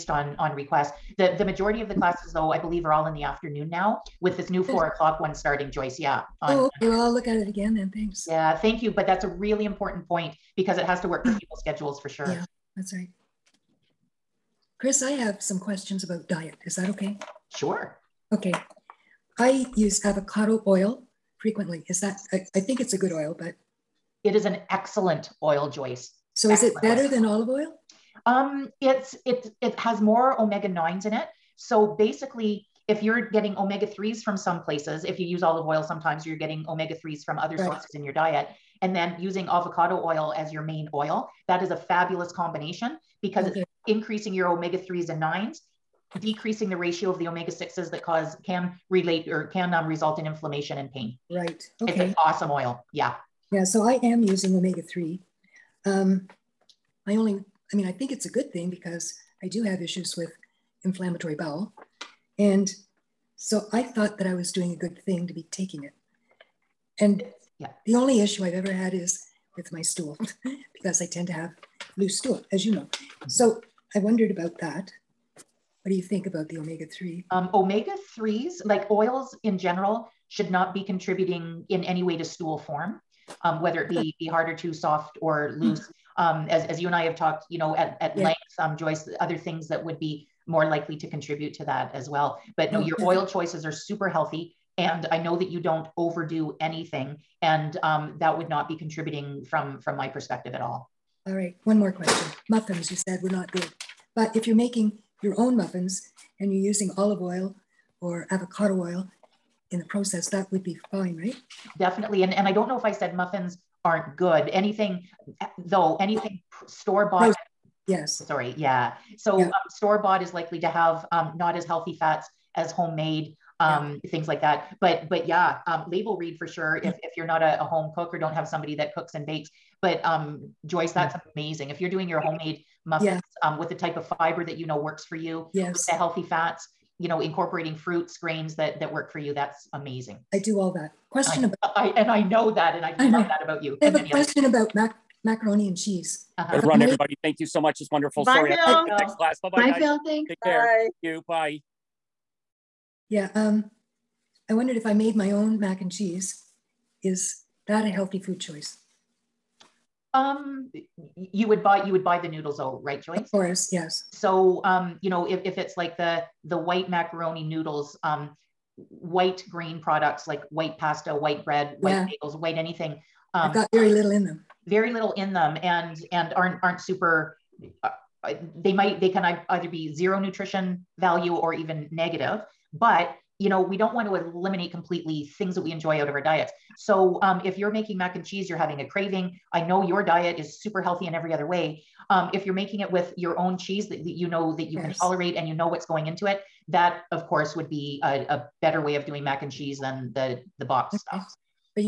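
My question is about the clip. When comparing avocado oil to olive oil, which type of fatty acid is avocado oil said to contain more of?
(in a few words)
omega 9s.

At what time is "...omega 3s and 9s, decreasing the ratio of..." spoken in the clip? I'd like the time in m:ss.
0:44.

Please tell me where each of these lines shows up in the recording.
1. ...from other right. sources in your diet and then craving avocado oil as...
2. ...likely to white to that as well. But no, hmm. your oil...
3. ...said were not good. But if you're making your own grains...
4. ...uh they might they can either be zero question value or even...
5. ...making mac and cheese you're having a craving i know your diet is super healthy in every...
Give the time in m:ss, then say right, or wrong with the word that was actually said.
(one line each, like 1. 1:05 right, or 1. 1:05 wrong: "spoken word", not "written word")
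1. 0:37 wrong: "using", not "craving"
2. 1:30 wrong: "contribute", not "white"
3. 1:42 wrong: "muffins", not "grains"
4. 2:58 wrong: "nutrition", not "question"
5. 3:07 right.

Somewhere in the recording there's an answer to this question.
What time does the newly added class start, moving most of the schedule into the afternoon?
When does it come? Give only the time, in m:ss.
0:04.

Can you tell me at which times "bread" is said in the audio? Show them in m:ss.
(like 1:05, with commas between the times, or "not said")
2:51.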